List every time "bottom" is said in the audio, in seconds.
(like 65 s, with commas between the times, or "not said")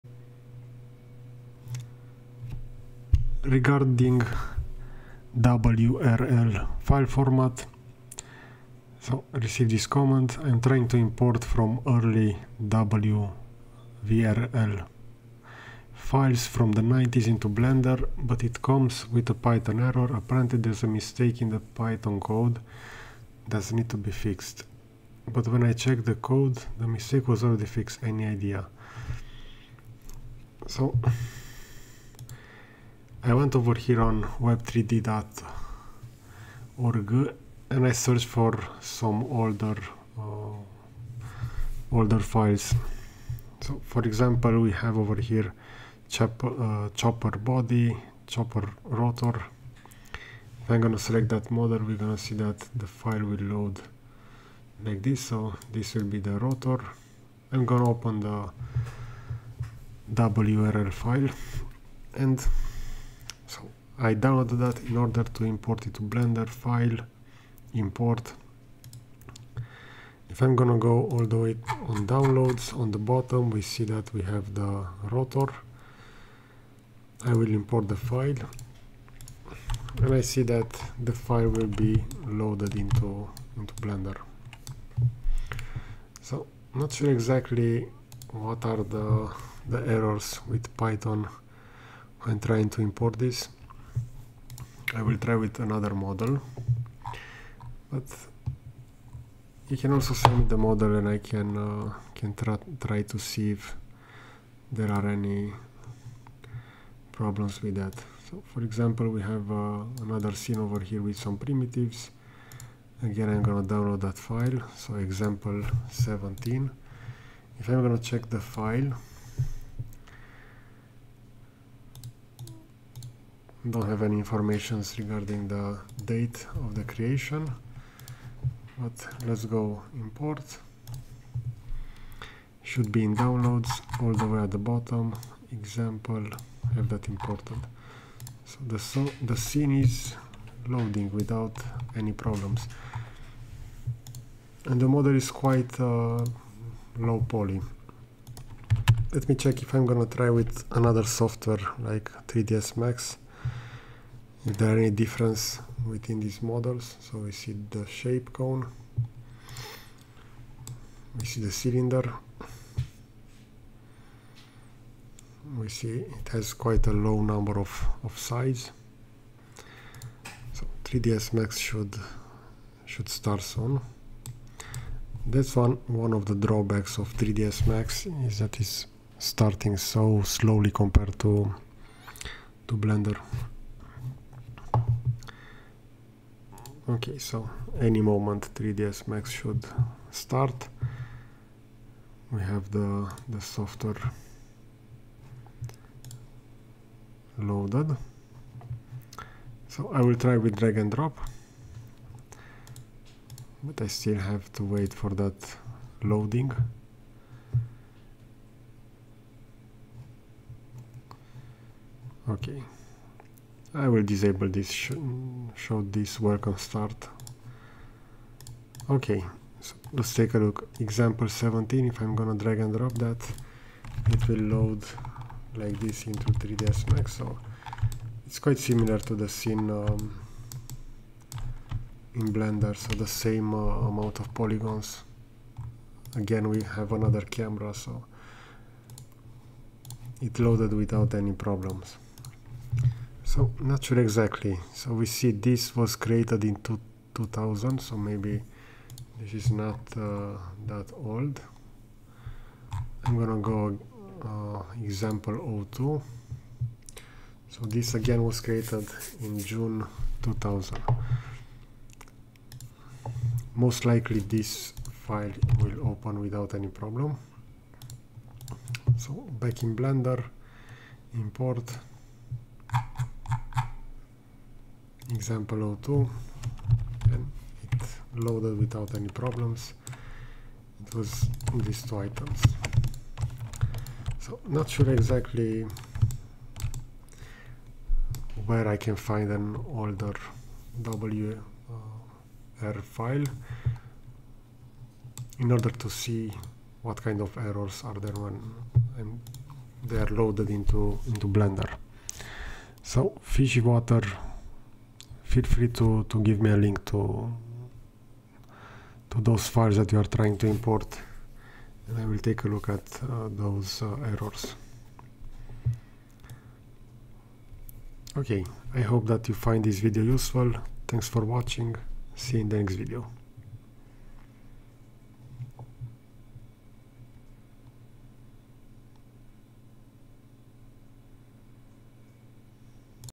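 72 s, 134 s.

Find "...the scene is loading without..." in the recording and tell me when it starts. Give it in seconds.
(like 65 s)
139 s.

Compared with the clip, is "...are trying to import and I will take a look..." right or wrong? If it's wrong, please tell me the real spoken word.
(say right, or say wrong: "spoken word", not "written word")
right.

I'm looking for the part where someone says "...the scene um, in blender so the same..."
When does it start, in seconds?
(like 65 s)
229 s.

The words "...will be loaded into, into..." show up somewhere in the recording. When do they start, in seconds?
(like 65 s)
81 s.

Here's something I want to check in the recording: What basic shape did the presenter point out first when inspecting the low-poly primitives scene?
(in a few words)
cone.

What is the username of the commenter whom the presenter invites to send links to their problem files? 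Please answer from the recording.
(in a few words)
fishy water.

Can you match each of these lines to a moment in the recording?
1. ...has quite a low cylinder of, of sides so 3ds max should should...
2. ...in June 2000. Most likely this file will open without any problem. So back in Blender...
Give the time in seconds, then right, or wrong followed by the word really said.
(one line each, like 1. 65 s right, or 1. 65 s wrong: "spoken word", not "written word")
1. 166 s wrong: "number", not "cylinder"
2. 259 s right.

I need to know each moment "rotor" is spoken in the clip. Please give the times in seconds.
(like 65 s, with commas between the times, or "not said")
48 s, 56 s, 75 s.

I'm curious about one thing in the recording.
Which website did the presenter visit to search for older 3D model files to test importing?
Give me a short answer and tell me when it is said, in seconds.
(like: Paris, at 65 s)
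web3d.org, at 34 s.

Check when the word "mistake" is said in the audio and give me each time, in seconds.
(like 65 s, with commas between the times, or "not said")
20 s, 26 s.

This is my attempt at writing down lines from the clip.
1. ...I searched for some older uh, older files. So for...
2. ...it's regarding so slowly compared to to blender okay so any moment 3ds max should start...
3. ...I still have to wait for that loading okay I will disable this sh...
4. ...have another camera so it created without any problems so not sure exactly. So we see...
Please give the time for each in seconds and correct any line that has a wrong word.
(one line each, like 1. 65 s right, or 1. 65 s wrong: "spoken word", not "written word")
1. 37 s right
2. 178 s wrong: "starting", not "regarding"
3. 203 s right
4. 236 s wrong: "loaded", not "created".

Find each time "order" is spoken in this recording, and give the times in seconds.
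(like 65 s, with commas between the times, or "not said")
64 s, 295 s.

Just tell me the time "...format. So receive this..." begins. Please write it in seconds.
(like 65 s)
7 s.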